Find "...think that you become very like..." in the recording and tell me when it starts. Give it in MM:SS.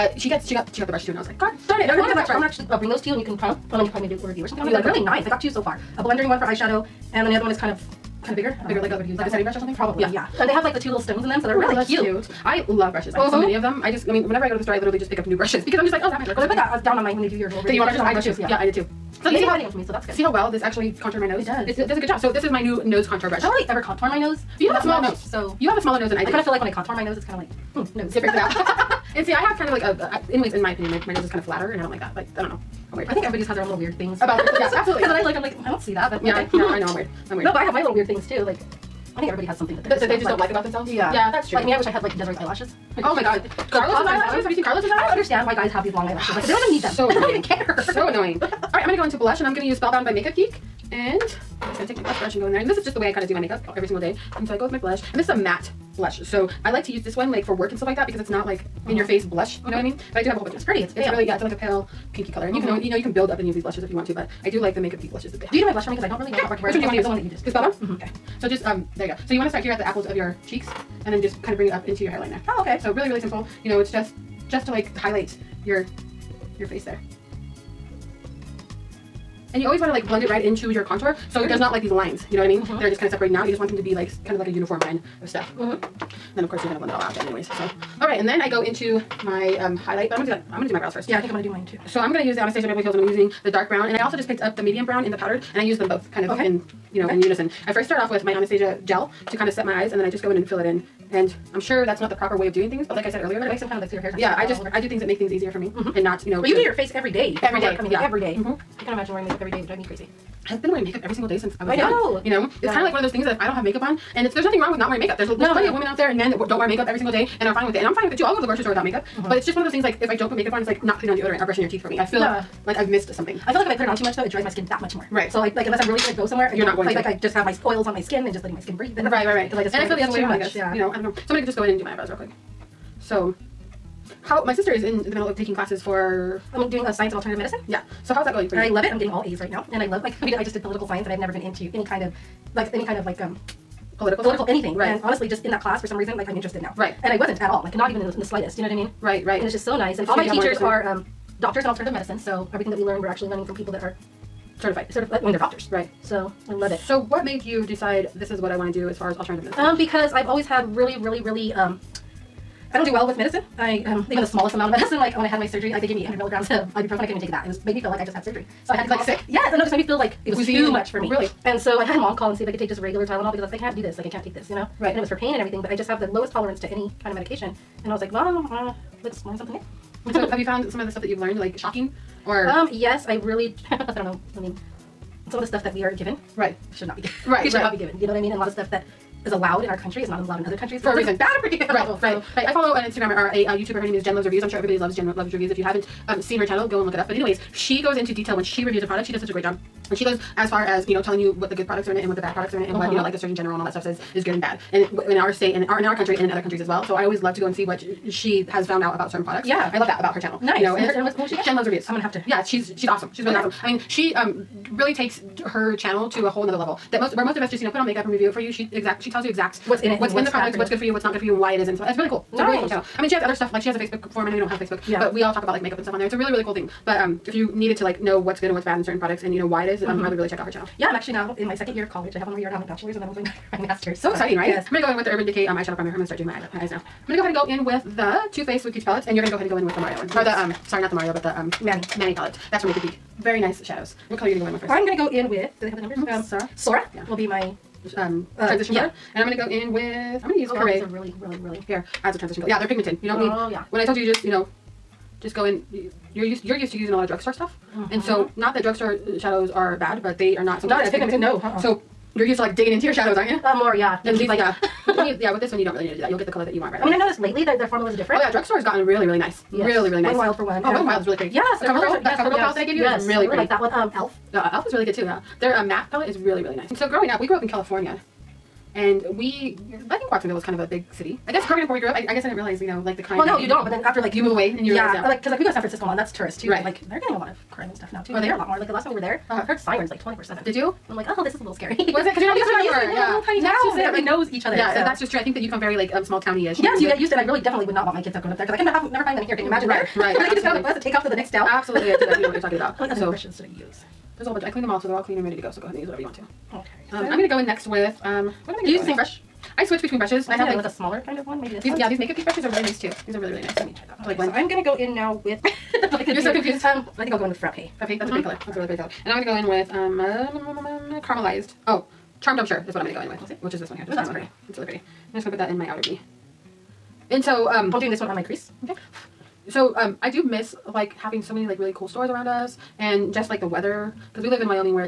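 04:55.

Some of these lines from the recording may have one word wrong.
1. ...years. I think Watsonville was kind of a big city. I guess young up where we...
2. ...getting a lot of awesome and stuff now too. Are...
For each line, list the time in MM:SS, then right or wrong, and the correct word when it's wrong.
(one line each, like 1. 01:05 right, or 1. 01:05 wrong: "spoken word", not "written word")
1. 04:39 wrong: "growing", not "young"
2. 04:46 wrong: "crime", not "awesome".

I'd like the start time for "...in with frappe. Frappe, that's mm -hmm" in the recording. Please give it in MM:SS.
05:17.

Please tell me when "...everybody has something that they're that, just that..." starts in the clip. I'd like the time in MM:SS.
00:39.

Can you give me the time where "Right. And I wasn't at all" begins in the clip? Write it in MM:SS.
02:26.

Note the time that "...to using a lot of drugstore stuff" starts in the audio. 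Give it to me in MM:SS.
04:16.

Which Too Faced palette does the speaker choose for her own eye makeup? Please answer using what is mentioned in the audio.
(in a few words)
Sweet Peach Palette.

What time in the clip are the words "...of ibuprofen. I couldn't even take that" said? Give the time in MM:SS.
02:46.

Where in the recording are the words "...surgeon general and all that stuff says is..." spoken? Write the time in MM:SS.
03:23.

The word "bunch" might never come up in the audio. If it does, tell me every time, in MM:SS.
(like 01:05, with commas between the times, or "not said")
01:00, 05:04.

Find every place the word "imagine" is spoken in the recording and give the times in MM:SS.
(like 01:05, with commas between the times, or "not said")
01:48, 04:59.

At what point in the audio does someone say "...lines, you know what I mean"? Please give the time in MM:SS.
01:21.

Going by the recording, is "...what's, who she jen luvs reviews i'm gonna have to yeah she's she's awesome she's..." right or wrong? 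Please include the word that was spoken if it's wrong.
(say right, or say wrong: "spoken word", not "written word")
right.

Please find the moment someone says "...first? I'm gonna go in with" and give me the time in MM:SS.
04:04.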